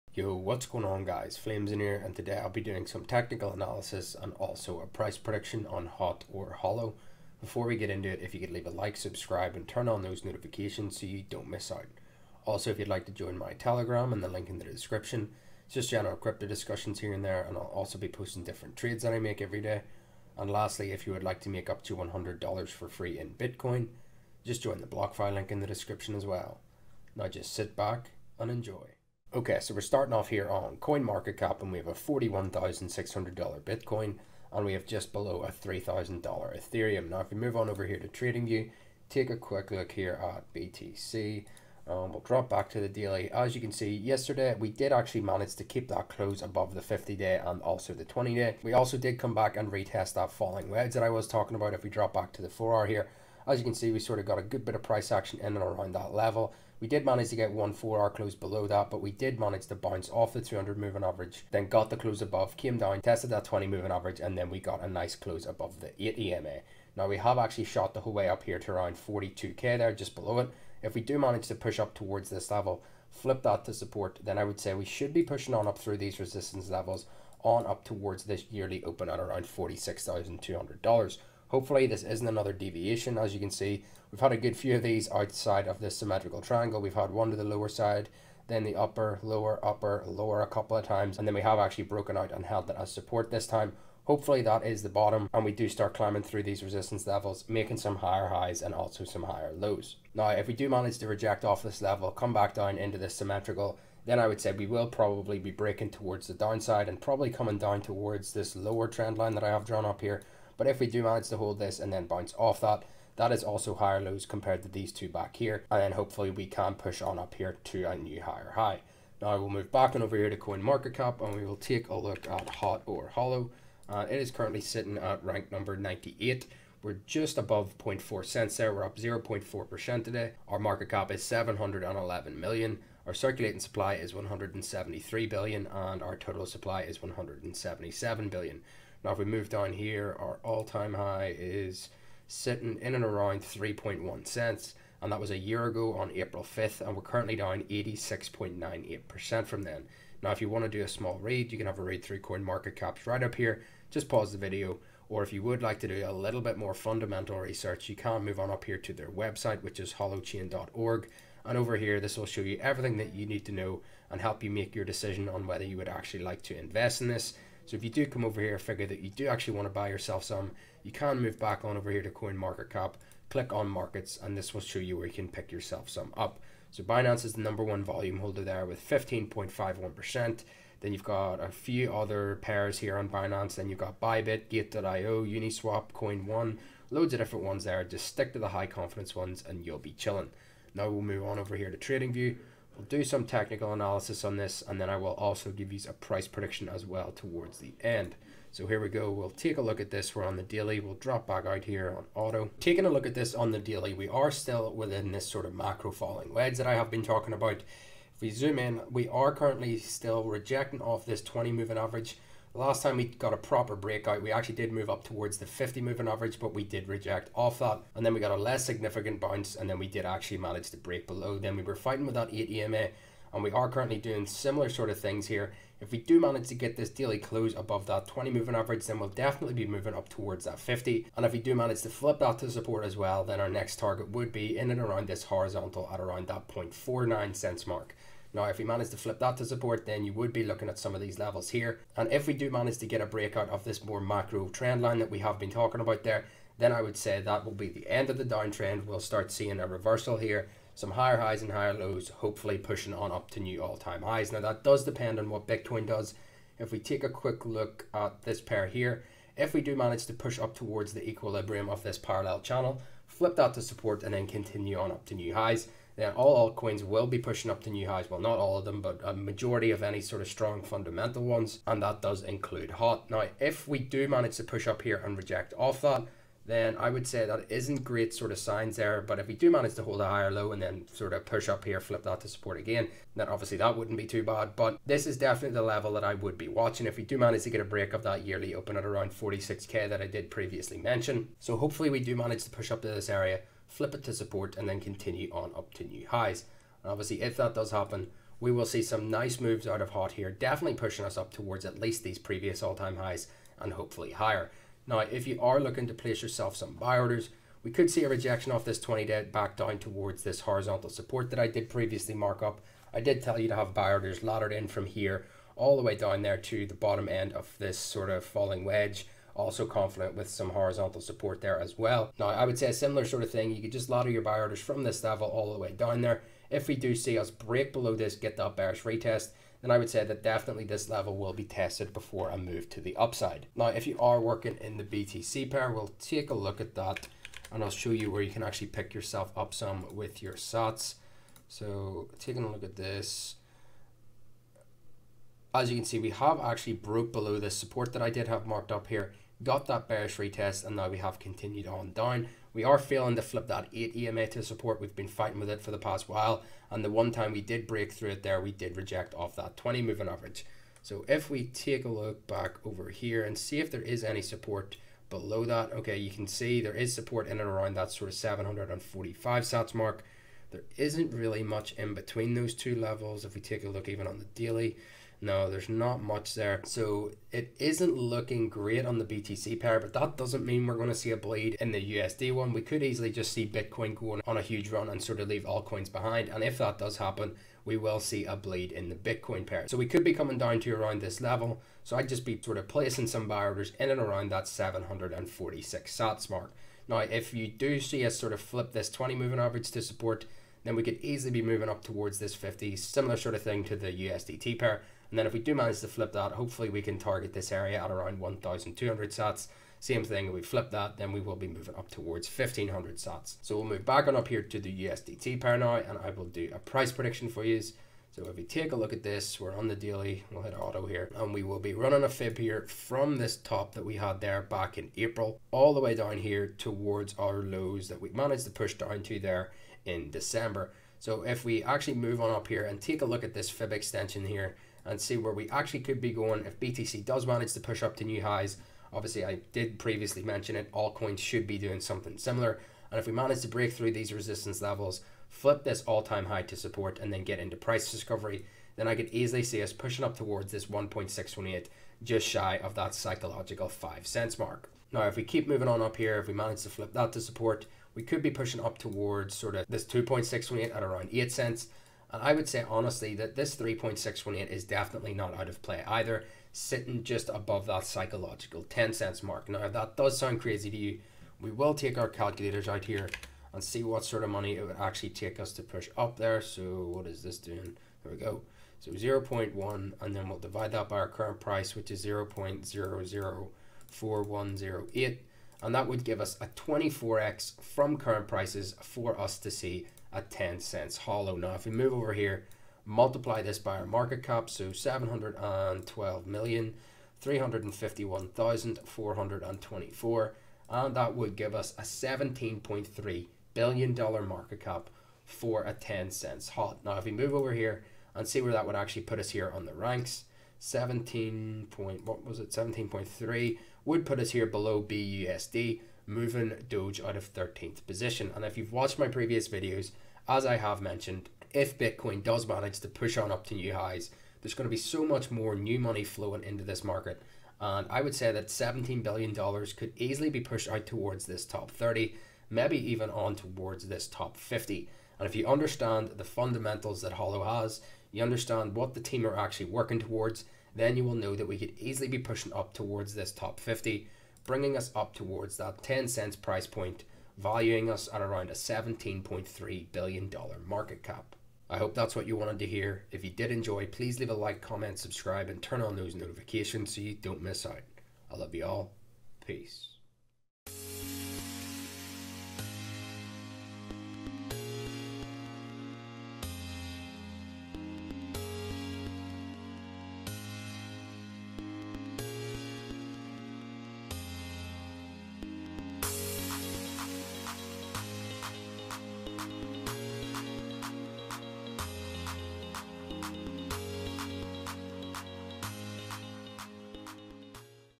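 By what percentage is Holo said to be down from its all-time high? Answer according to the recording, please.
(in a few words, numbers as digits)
86.98%.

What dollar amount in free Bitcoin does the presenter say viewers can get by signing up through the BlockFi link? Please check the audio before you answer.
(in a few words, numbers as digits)
$100.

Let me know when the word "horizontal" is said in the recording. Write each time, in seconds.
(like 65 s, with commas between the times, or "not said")
235 s, 310 s, 320 s.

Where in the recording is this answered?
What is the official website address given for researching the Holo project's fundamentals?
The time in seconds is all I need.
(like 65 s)
159 s.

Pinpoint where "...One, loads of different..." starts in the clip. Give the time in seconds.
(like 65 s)
186 s.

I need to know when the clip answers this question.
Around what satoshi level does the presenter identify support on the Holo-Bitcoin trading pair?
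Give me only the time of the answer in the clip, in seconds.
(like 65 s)
368 s.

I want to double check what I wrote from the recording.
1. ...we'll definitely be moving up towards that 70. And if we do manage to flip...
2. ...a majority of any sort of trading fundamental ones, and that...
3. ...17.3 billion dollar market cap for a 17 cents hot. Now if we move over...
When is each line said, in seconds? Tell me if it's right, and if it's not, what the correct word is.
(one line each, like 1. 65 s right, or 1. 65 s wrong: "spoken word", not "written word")
1. 228 s wrong: "50", not "70"
2. 269 s wrong: "strong", not "trading"
3. 501 s wrong: "10", not "17".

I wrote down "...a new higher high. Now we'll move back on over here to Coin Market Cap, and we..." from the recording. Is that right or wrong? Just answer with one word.
right.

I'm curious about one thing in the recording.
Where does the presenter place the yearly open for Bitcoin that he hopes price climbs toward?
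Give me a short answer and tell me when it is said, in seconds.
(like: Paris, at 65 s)
$46,200, at 79 s.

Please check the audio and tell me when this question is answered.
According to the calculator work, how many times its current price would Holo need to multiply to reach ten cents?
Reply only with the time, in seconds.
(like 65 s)
486 s.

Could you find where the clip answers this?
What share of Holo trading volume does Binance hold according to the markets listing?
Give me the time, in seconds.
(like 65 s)
178 s.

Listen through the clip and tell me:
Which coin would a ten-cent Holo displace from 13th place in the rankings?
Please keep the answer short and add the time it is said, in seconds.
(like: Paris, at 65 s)
Doge, at 516 s.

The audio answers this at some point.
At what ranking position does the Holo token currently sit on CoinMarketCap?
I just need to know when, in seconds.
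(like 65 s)
125 s.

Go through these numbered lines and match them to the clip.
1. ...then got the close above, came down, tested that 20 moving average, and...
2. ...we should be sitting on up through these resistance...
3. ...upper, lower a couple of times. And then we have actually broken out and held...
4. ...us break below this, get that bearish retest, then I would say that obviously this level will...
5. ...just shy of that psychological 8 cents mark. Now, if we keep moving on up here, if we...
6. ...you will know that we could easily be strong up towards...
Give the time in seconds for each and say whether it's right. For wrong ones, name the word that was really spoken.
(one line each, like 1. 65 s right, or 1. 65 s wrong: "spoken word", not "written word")
1. 61 s right
2. 74 s wrong: "pushing", not "sitting"
3. 89 s right
4. 327 s wrong: "definitely", not "obviously"
5. 452 s wrong: "5", not "8"
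6. 540 s wrong: "pushing", not "strong".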